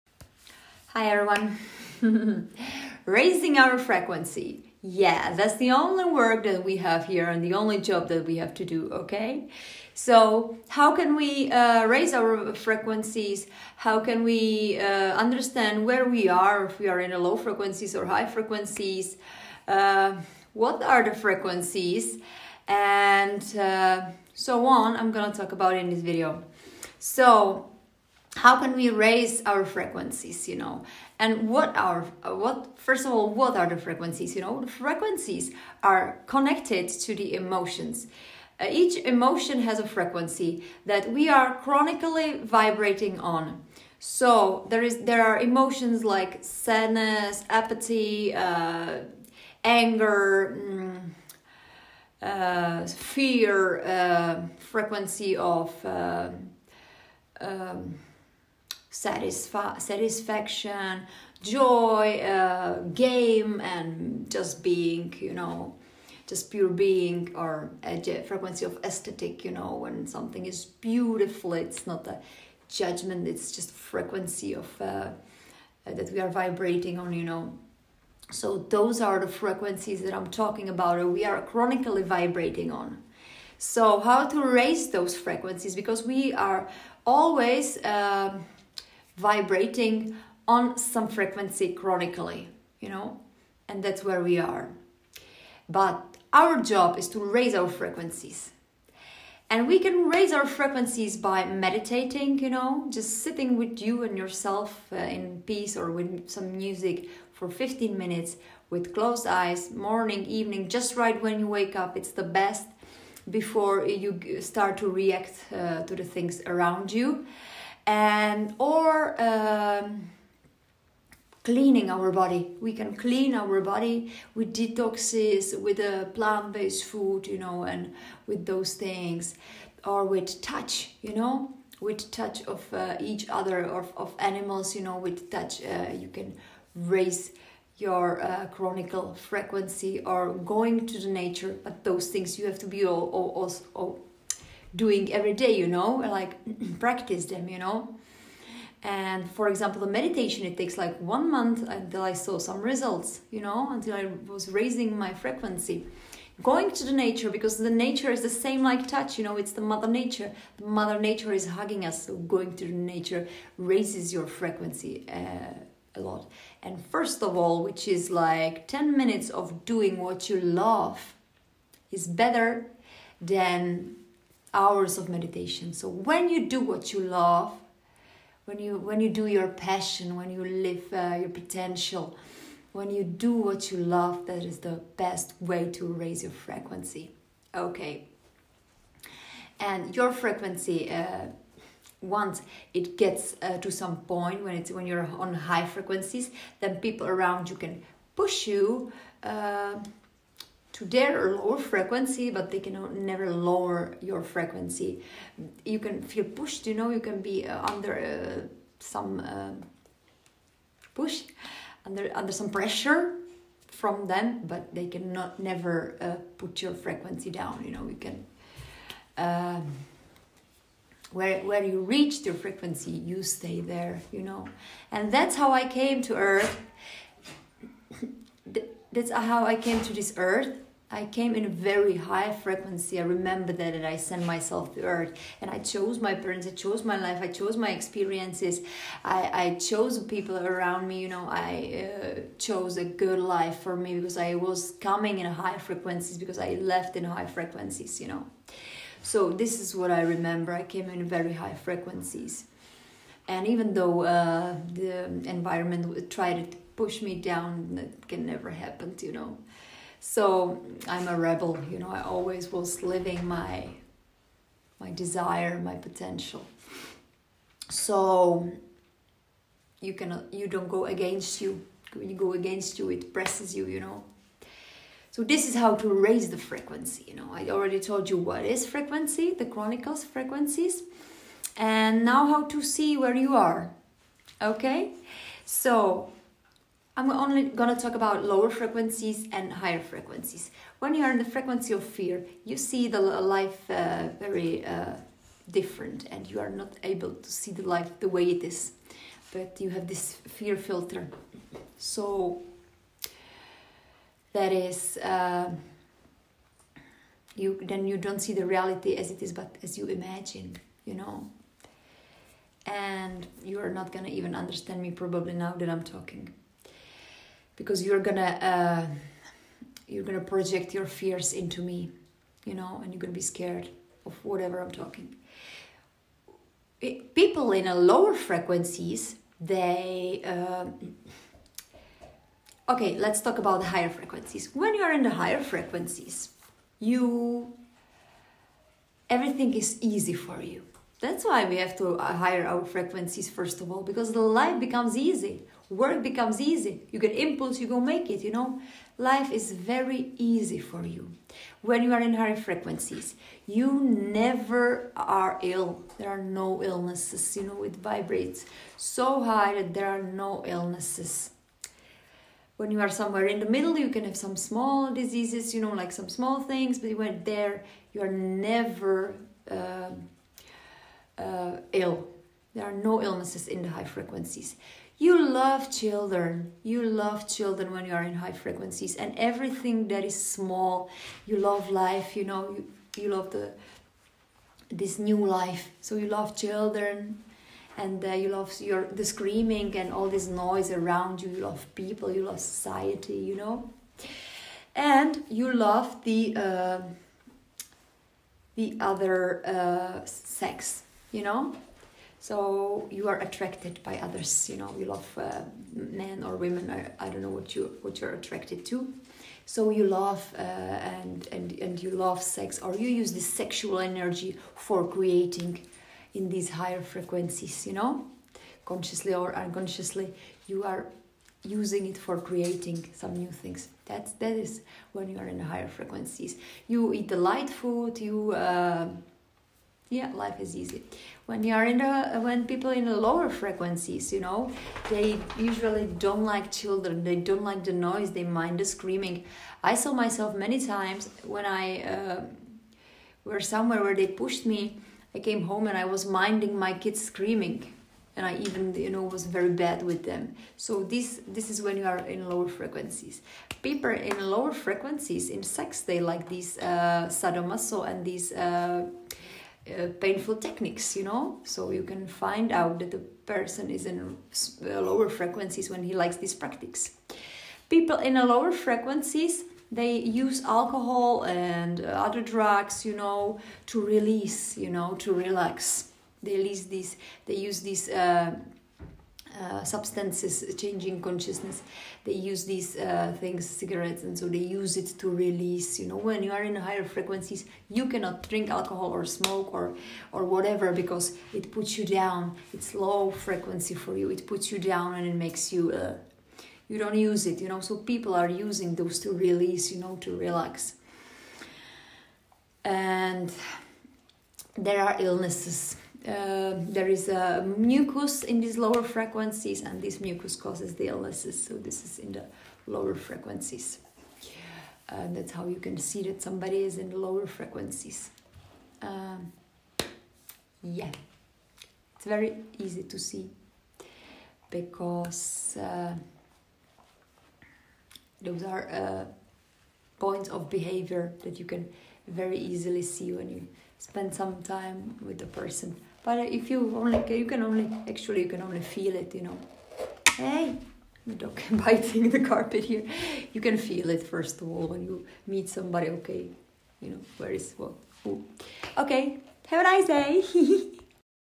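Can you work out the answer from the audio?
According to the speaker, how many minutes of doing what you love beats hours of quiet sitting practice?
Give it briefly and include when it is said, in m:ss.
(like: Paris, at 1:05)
10, at 2:48.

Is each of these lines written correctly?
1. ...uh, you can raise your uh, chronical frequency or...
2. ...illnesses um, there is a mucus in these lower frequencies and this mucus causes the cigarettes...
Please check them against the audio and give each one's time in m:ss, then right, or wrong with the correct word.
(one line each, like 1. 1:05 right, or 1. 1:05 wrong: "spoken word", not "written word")
1. 2:15 right
2. 8:24 wrong: "illnesses", not "cigarettes".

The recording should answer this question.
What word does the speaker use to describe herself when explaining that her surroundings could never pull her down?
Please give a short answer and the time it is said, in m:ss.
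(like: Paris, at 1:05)
rebel, at 4:20.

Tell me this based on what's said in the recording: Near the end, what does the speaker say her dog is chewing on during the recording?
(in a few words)
the carpet.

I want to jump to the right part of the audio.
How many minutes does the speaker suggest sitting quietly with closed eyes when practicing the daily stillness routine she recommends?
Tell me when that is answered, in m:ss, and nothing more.
1:47.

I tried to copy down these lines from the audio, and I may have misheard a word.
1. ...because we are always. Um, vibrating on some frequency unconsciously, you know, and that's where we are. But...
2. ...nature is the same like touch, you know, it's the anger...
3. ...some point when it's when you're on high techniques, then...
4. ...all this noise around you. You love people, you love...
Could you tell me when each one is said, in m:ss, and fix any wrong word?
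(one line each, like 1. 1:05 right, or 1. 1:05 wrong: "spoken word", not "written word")
1. 1:25 wrong: "chronically", not "unconsciously"
2. 2:37 wrong: "mother", not "anger"
3. 3:13 wrong: "frequencies", not "techniques"
4. 6:29 right.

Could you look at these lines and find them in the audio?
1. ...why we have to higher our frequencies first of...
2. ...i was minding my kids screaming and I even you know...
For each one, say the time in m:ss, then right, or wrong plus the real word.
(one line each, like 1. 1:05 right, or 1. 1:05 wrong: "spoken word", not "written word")
1. 5:41 right
2. 7:25 right.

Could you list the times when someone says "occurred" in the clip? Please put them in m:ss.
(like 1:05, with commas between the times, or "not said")
not said.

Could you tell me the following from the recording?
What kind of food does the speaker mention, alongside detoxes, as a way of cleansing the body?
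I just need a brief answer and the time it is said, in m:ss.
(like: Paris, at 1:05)
plant-based food, at 2:06.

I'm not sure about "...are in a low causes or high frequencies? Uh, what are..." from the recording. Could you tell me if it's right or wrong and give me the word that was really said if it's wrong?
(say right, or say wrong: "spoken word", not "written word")
wrong: "frequencies", not "causes".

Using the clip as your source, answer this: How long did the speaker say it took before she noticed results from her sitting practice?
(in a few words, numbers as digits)
one month.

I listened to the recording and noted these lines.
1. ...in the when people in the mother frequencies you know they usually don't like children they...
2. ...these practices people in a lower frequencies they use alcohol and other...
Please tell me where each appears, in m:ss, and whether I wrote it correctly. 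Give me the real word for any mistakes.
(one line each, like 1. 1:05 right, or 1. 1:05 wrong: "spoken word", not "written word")
1. 7:11 wrong: "lower", not "mother"
2. 7:46 right.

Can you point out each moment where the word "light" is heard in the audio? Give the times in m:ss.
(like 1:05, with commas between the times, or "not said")
7:07.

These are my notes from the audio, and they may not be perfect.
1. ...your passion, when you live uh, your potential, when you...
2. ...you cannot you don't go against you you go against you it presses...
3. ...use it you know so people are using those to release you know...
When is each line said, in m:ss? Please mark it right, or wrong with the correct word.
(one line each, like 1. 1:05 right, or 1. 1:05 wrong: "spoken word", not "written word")
1. 2:59 right
2. 4:29 right
3. 8:16 right.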